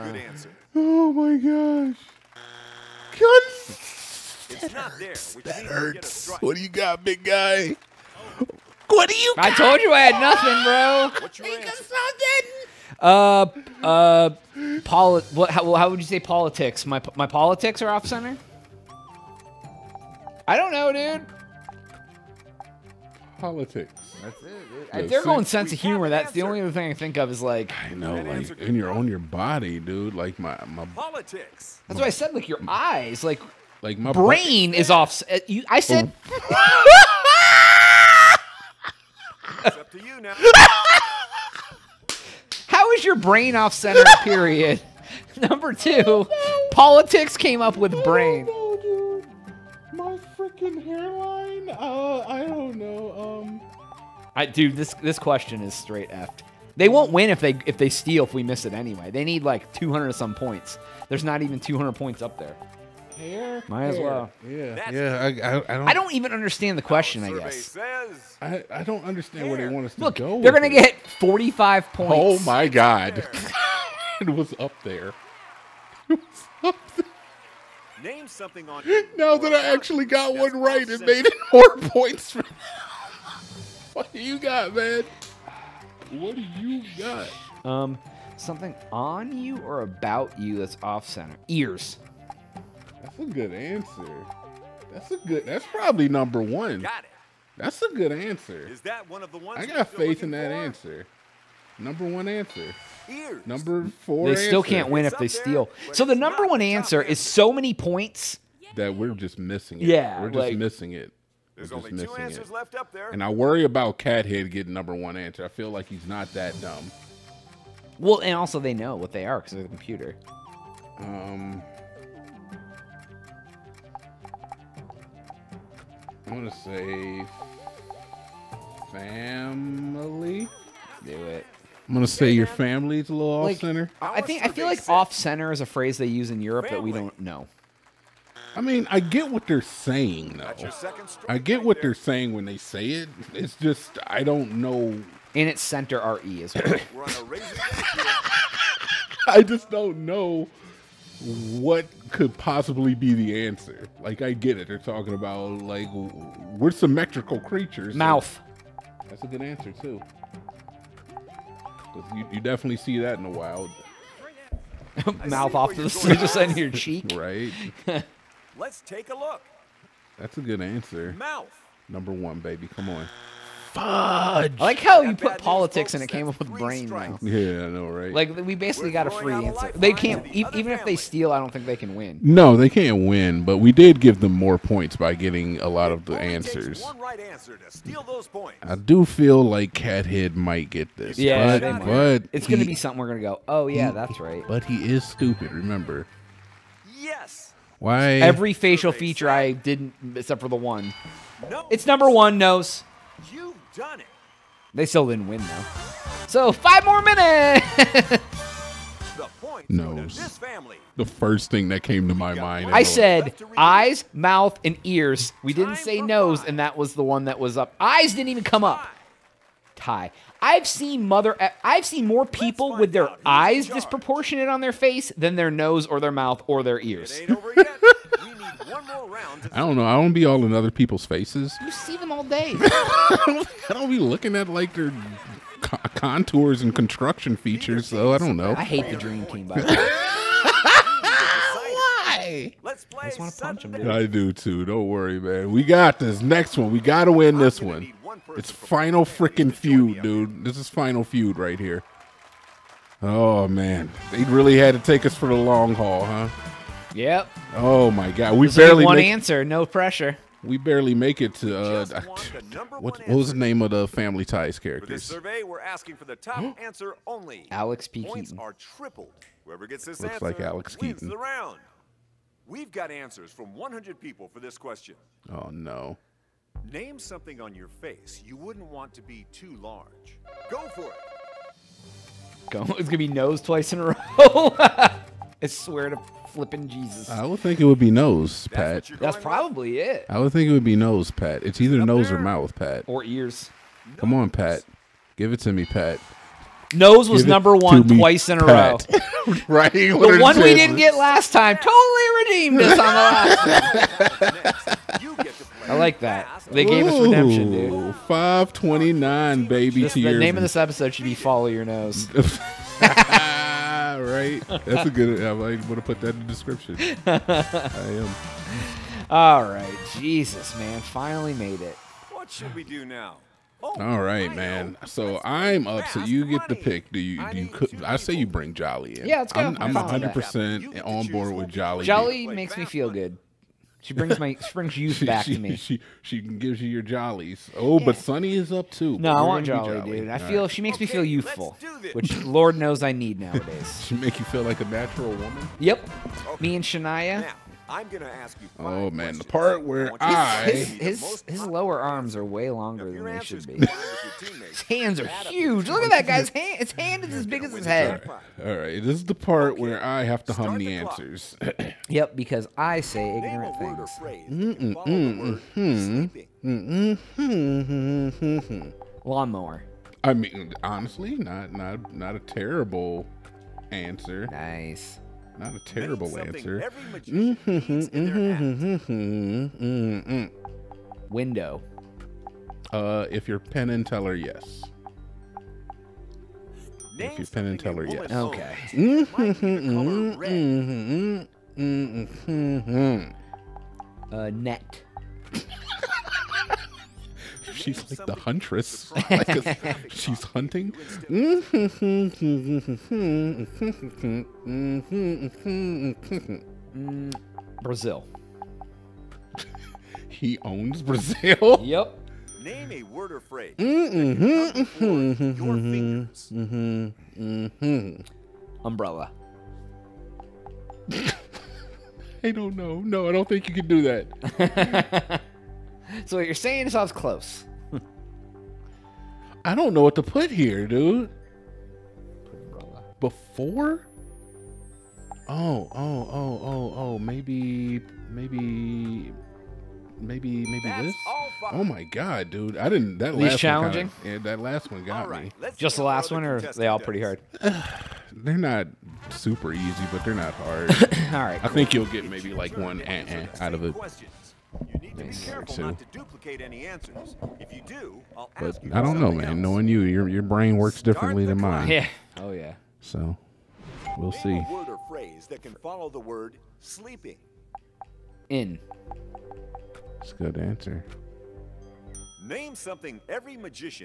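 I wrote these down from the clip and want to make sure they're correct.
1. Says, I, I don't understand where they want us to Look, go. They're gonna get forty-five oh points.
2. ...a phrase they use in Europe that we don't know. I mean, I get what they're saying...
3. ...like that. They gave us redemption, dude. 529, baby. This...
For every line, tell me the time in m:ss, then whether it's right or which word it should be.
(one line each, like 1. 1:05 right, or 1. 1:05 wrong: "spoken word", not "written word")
1. 1:07 right
2. 2:15 right
3. 5:05 right.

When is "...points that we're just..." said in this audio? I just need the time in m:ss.
1:47.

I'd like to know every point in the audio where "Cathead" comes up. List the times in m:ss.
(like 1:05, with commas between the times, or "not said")
1:53, 3:09.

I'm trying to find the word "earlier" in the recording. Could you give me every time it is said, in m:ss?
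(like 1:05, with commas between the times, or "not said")
not said.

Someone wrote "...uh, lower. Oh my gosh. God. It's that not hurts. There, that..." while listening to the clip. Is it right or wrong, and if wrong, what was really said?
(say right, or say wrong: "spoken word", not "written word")
wrong: "answer", not "lower".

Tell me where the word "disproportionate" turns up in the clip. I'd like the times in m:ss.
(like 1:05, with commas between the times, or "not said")
3:43.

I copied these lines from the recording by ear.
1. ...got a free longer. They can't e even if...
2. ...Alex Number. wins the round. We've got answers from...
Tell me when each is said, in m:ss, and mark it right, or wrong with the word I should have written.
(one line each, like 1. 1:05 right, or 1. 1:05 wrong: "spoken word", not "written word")
1. 2:58 wrong: "answer", not "longer"
2. 4:30 wrong: "Keaton", not "Number".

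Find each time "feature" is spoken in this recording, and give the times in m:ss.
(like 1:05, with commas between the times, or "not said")
3:18, 3:57.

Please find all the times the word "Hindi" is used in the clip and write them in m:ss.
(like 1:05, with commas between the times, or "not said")
not said.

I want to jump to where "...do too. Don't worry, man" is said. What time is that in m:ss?
4:04.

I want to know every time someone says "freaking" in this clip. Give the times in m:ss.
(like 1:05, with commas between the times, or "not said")
0:50, 4:09.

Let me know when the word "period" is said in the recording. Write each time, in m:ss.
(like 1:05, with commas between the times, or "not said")
0:44.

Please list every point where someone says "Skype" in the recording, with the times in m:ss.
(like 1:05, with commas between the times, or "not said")
not said.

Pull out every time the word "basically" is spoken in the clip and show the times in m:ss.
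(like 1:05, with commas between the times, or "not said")
2:58.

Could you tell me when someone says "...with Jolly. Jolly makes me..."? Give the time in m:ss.
5:31.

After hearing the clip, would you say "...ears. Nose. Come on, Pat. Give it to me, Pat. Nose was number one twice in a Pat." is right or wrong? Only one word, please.
right.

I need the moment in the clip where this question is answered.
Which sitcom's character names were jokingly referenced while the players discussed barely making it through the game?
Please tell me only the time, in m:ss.
4:23.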